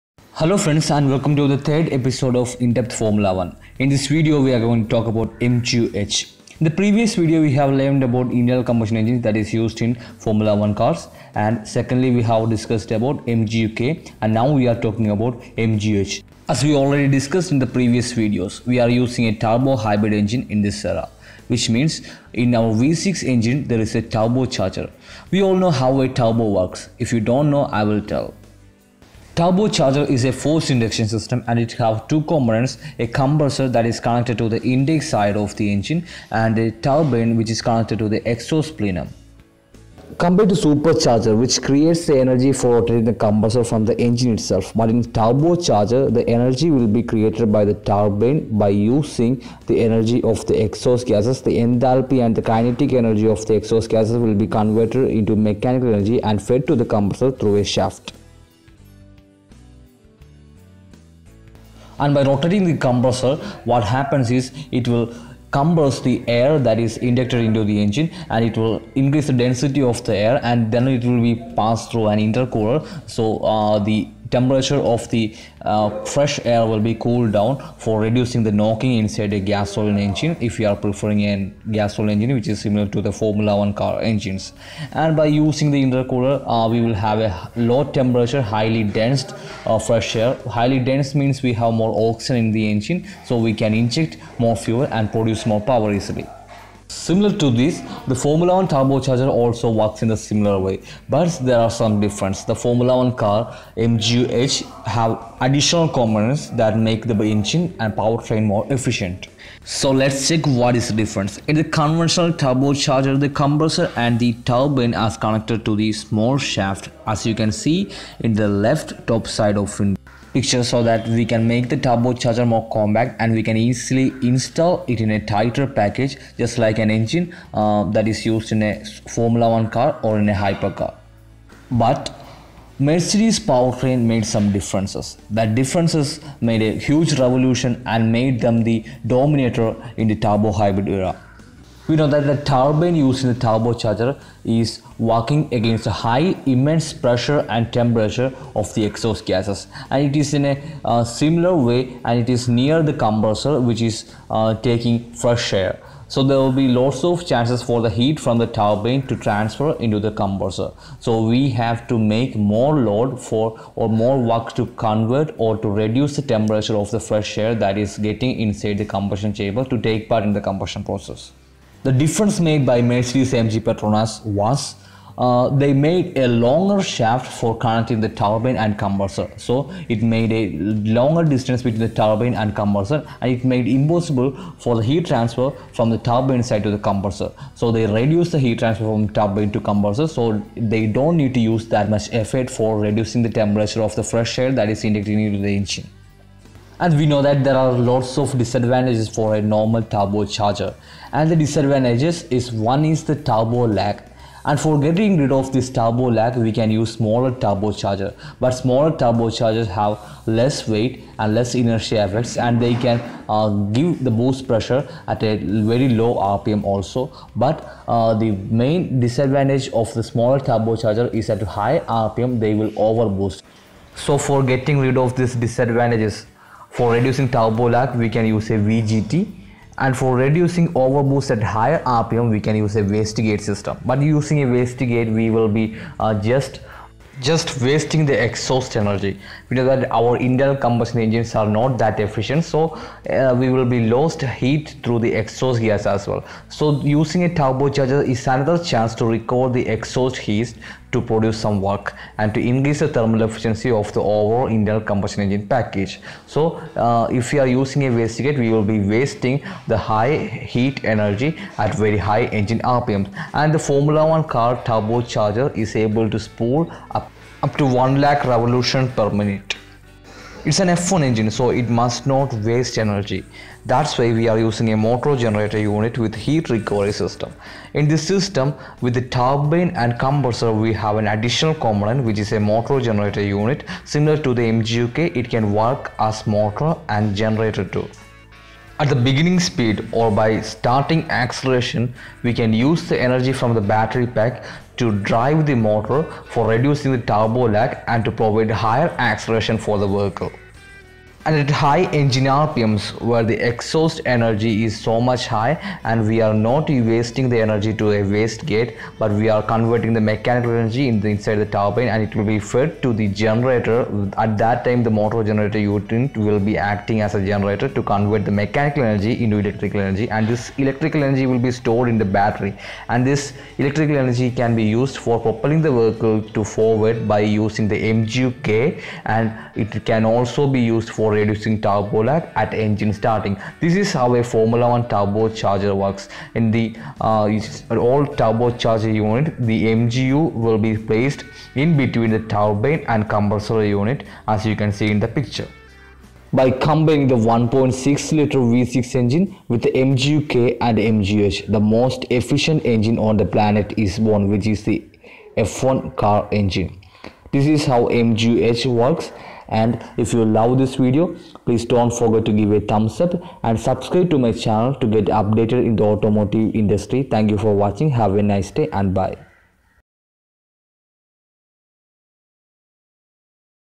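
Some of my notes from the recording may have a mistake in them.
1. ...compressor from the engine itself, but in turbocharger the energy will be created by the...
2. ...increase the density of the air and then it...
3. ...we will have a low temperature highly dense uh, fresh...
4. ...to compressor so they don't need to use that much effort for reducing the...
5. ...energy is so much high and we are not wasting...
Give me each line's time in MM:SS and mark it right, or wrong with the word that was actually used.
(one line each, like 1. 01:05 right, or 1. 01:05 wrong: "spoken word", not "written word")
1. 00:43 right
2. 01:08 right
3. 01:26 right
4. 03:09 right
5. 05:04 right.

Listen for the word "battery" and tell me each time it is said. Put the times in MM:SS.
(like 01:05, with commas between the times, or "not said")
04:53, 05:22.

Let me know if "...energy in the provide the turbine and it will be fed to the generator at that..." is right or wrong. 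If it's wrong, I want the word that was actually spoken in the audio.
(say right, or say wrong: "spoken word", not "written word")
wrong: "inside", not "provide".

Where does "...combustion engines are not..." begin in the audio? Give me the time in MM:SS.
04:00.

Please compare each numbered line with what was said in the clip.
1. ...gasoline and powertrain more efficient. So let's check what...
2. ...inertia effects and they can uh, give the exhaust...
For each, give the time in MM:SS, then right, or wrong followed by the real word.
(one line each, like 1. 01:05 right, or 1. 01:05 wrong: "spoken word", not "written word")
1. 01:47 wrong: "engine", not "gasoline"
2. 03:31 wrong: "boost", not "exhaust".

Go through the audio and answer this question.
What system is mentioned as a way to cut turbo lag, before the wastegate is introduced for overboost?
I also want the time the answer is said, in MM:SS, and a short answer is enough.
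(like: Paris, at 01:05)
VGT, at 03:48.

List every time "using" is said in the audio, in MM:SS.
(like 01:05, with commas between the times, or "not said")
00:18, 00:48, 01:25, 03:54, 04:06, 04:17, 04:34, 05:27.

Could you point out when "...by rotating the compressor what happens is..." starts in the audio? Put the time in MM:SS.
01:02.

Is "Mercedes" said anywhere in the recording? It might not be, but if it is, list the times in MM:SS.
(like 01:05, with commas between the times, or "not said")
02:12, 02:52.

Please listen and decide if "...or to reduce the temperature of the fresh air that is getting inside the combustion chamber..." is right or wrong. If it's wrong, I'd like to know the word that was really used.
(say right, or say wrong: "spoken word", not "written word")
right.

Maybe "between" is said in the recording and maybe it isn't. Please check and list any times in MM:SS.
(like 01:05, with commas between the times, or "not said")
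03:01, 05:41.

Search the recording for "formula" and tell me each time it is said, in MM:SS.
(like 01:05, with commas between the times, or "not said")
00:02, 00:10, 01:23, 01:38, 01:42, 02:09, 04:23, 05:34.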